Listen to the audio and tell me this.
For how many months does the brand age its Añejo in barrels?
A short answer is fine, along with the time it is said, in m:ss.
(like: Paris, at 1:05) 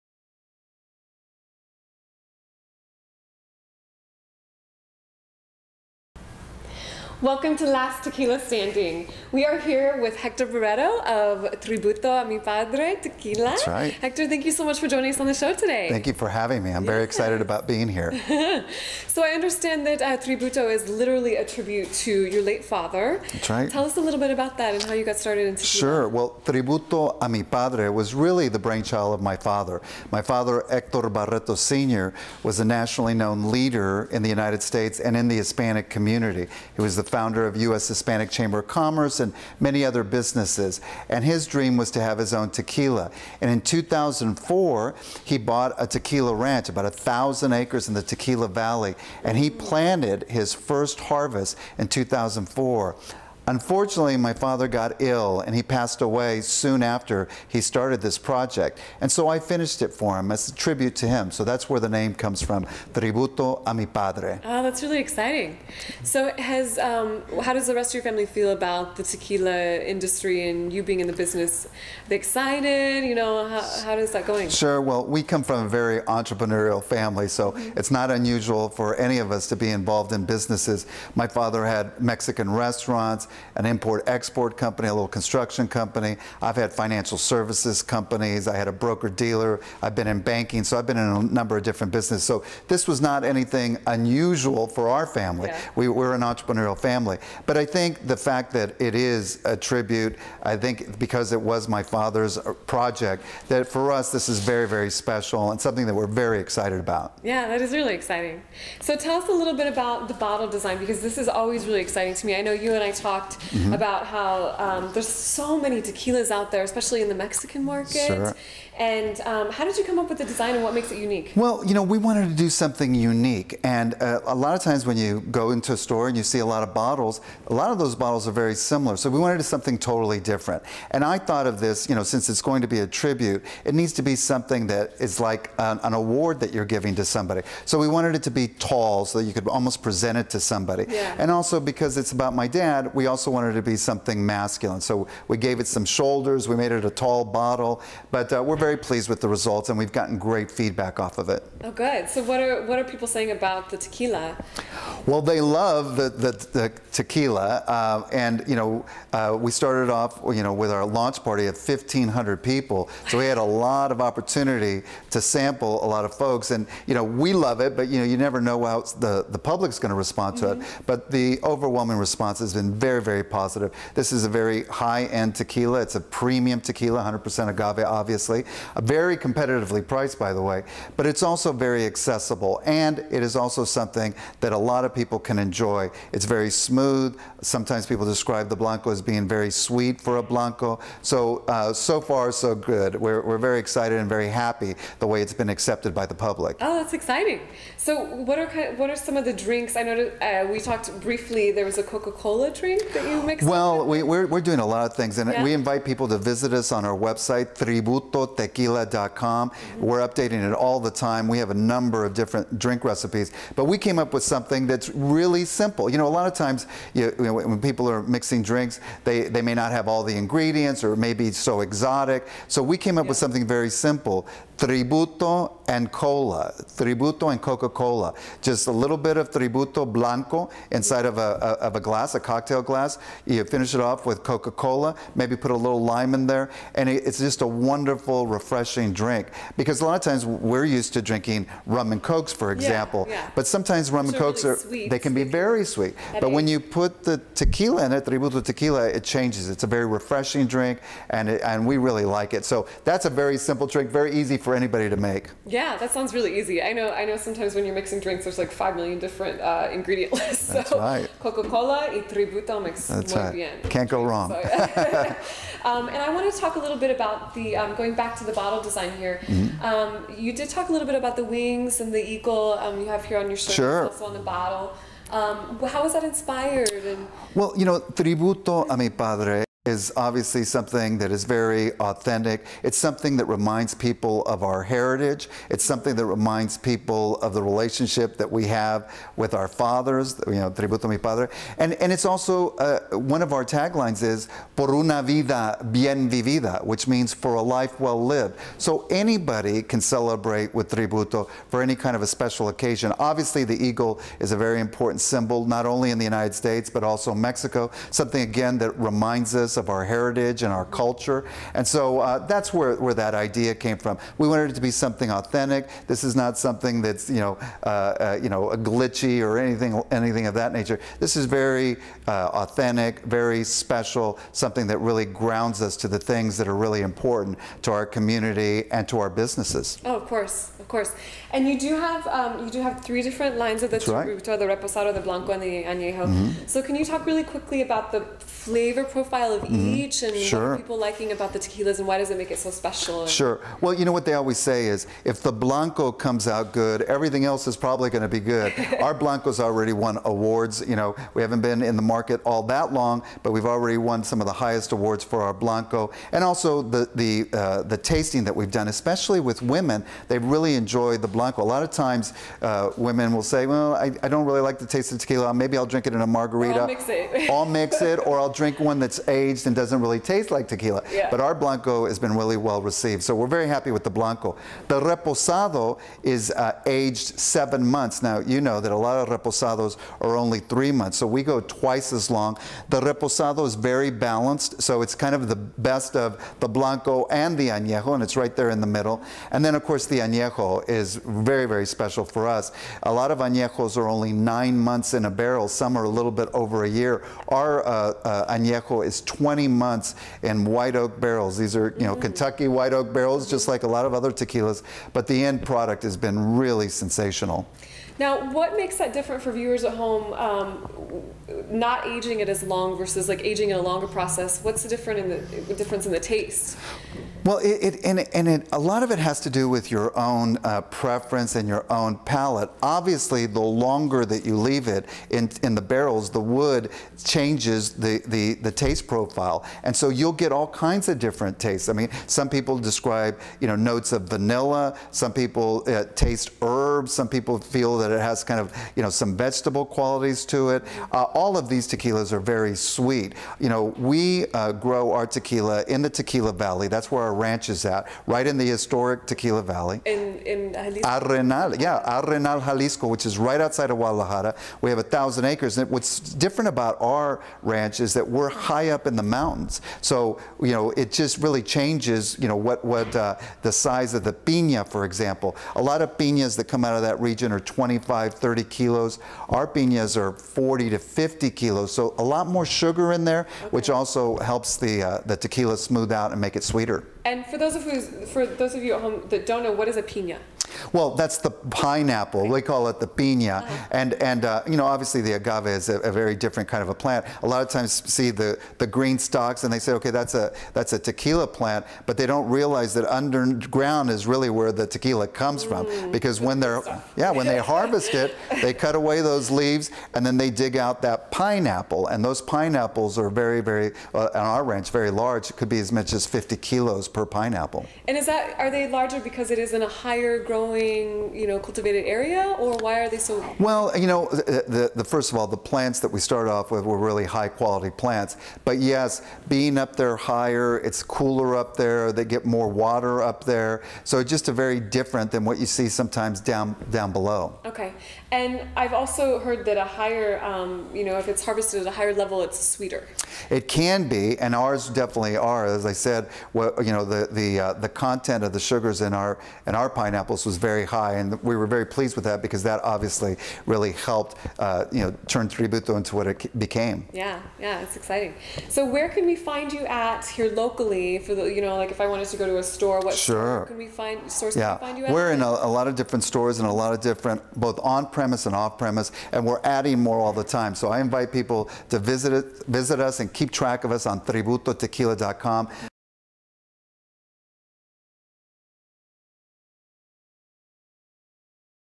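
20 months, at 6:39.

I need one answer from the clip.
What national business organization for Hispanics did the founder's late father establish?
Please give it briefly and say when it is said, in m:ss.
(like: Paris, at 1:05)
U.S. Hispanic Chamber of Commerce, at 0:37.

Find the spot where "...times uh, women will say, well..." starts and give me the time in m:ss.
6:01.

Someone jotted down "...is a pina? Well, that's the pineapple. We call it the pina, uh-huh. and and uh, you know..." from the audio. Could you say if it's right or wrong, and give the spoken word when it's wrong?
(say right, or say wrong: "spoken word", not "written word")
right.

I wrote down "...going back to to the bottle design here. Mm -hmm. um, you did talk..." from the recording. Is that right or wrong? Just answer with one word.
right.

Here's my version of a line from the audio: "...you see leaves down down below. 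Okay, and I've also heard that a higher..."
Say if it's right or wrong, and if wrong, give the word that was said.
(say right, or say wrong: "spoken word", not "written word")
wrong: "sometimes", not "leaves".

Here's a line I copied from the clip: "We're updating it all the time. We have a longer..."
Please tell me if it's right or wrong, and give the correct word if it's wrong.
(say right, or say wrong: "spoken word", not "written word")
wrong: "number", not "longer".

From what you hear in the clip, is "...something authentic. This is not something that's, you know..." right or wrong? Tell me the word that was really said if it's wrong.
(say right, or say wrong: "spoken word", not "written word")
right.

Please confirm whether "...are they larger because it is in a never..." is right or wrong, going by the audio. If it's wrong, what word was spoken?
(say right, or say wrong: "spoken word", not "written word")
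wrong: "higher", not "never".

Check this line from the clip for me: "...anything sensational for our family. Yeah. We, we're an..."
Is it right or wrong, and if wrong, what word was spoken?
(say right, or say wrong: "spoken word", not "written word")
wrong: "unusual", not "sensational".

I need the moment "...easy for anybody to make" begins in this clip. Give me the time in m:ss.
4:14.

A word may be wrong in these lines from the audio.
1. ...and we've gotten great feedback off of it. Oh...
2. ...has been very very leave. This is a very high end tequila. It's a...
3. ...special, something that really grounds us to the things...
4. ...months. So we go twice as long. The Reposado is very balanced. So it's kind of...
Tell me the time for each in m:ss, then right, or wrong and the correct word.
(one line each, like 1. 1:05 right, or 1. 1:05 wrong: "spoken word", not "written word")
1. 2:29 right
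2. 2:52 wrong: "positive", not "leave"
3. 5:23 right
4. 6:20 right.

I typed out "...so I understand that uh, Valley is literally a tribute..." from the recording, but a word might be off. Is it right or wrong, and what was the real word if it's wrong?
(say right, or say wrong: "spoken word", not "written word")
wrong: "Tributo", not "Valley".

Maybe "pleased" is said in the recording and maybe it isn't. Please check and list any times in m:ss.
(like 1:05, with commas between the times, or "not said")
2:28, 9:01.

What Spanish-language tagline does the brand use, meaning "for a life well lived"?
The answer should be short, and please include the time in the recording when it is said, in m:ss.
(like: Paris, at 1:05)
Por una vida bien vivida, at 4:54.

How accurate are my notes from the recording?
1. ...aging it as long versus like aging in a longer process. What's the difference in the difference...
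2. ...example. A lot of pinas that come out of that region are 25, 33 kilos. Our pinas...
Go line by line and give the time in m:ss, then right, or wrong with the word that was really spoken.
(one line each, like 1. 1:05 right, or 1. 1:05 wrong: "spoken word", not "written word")
1. 6:51 right
2. 7:44 wrong: "30", not "33".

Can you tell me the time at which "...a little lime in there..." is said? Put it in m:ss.
3:55.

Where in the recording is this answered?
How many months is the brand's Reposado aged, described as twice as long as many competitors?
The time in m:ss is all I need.
6:17.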